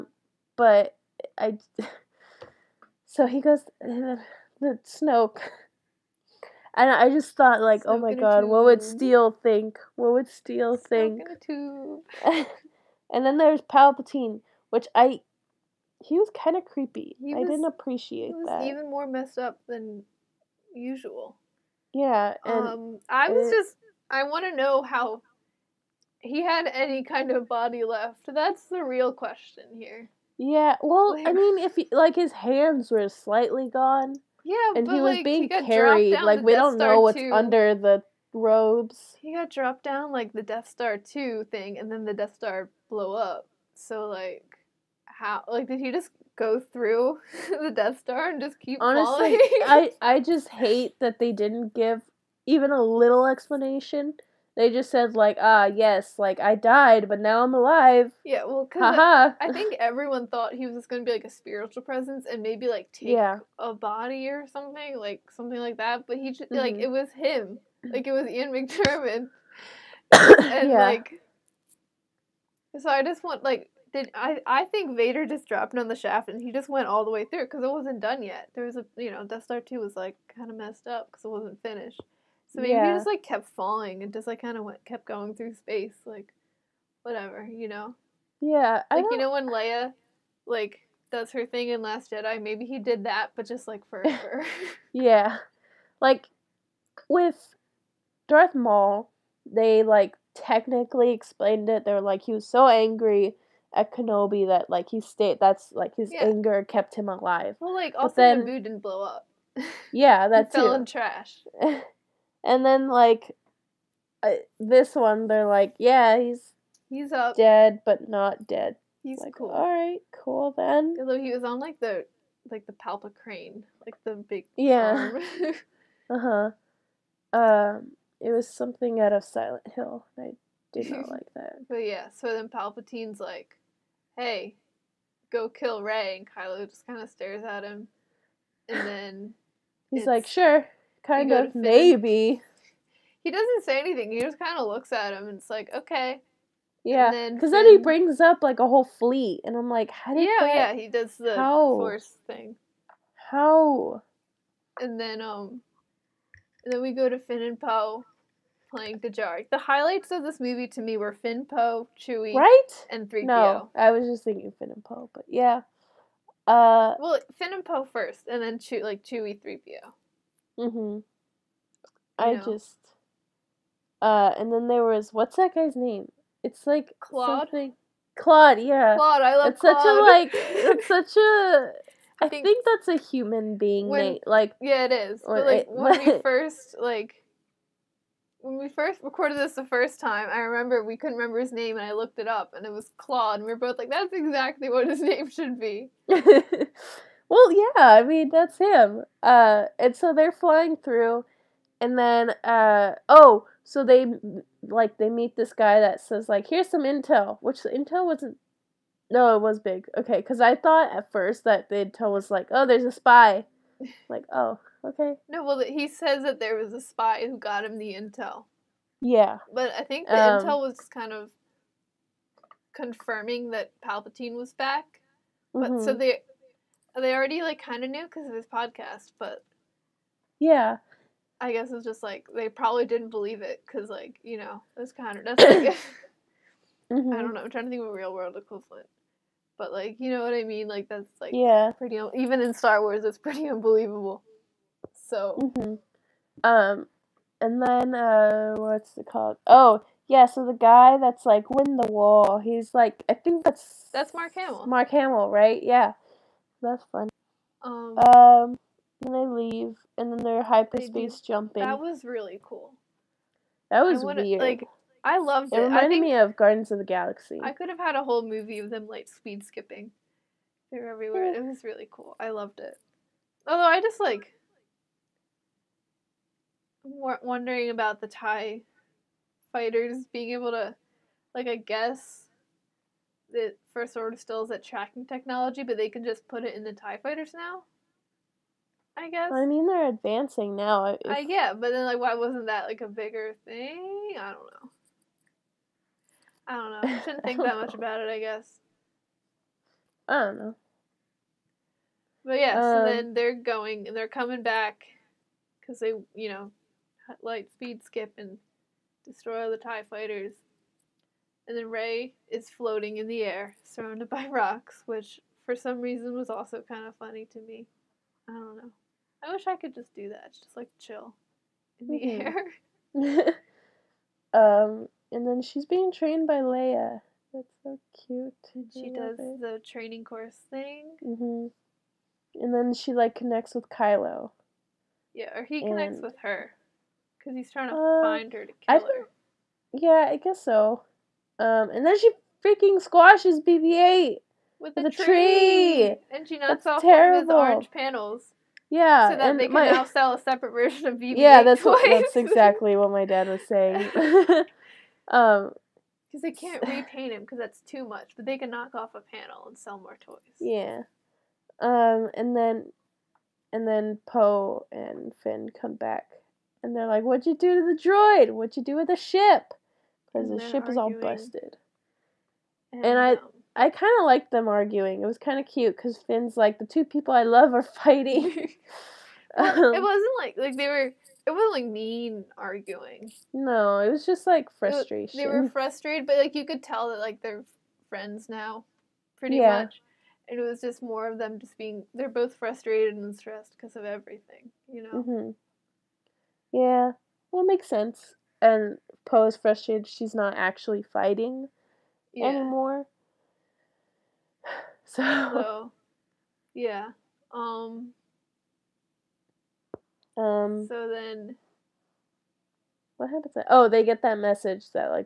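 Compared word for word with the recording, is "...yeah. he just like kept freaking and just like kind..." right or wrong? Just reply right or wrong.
wrong.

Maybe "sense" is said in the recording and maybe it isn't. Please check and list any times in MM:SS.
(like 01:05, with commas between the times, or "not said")
06:37.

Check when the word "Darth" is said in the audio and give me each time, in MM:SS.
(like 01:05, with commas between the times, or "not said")
01:38.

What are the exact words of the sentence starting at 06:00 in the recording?
Yeah, um, and then, and then Poe and Finn come back and they're like, "What'd you do to the droid?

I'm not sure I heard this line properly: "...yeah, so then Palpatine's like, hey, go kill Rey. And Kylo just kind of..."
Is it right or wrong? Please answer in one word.
right.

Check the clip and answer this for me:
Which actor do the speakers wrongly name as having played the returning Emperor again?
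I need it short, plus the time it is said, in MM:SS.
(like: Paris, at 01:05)
Ian McDermott, at 01:08.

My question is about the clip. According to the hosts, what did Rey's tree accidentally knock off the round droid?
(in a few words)
one of his orange panels.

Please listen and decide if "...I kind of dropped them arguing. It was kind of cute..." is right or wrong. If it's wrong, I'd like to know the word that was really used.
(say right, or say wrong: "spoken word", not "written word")
wrong: "liked", not "dropped".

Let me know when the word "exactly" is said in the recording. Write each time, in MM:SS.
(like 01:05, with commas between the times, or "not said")
03:14, 05:52.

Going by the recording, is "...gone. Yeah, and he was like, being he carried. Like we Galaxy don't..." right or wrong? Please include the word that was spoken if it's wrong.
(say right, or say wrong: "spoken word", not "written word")
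wrong: "Death", not "Galaxy".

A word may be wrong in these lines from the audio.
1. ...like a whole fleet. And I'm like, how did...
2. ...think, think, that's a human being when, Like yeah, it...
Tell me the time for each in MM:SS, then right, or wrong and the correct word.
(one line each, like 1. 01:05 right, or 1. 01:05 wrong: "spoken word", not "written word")
1. 02:28 right
2. 03:02 right.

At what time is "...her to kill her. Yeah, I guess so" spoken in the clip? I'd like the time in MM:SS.
05:38.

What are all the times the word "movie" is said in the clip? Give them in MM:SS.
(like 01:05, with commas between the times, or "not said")
02:40, 04:28.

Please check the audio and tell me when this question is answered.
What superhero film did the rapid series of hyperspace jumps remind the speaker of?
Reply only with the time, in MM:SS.
04:26.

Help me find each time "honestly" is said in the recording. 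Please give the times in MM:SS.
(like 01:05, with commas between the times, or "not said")
00:48.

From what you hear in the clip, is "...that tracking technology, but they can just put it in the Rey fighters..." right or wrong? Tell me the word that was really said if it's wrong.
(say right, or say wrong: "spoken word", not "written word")
wrong: "Tie", not "Rey".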